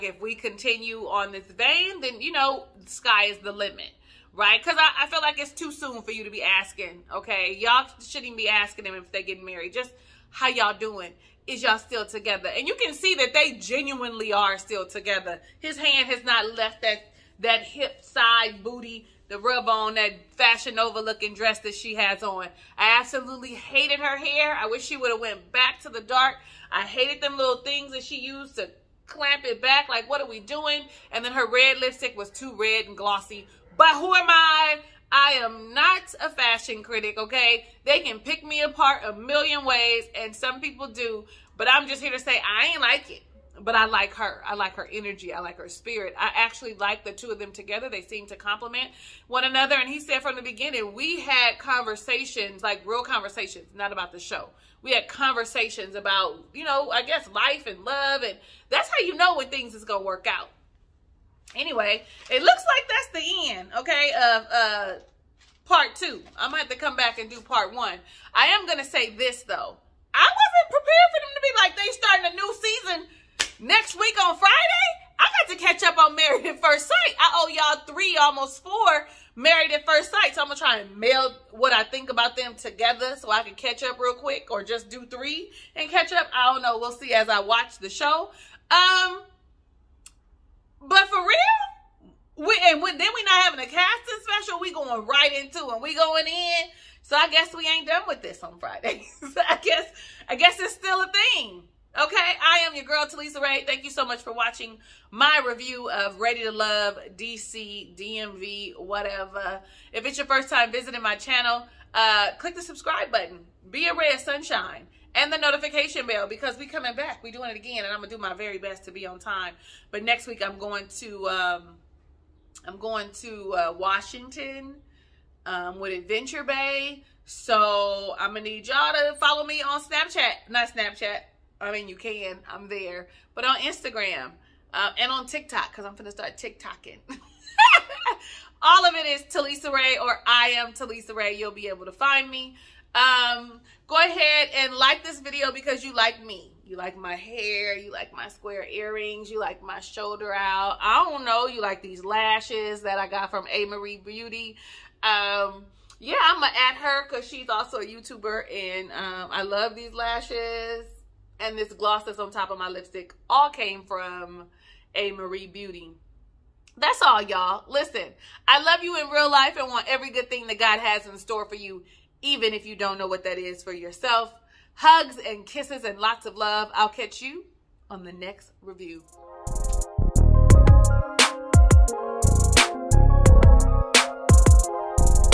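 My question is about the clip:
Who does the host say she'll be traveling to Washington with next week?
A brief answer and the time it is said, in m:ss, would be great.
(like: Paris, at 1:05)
Adventure Bay, at 2:05.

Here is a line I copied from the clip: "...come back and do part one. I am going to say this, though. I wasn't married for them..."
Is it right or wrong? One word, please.
wrong.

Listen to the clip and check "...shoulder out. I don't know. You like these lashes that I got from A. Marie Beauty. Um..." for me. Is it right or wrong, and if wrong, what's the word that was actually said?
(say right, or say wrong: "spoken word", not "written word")
right.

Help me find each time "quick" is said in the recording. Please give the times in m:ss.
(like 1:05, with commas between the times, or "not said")
1:24.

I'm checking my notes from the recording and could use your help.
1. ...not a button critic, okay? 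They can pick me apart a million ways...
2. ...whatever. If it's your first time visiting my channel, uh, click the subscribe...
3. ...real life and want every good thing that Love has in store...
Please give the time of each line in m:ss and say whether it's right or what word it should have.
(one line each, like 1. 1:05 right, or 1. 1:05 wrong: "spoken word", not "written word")
1. 0:35 wrong: "fashion", not "button"
2. 1:48 right
3. 2:49 wrong: "God", not "Love".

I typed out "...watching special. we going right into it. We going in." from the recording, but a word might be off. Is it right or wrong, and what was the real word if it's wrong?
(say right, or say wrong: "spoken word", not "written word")
wrong: "casting", not "watching".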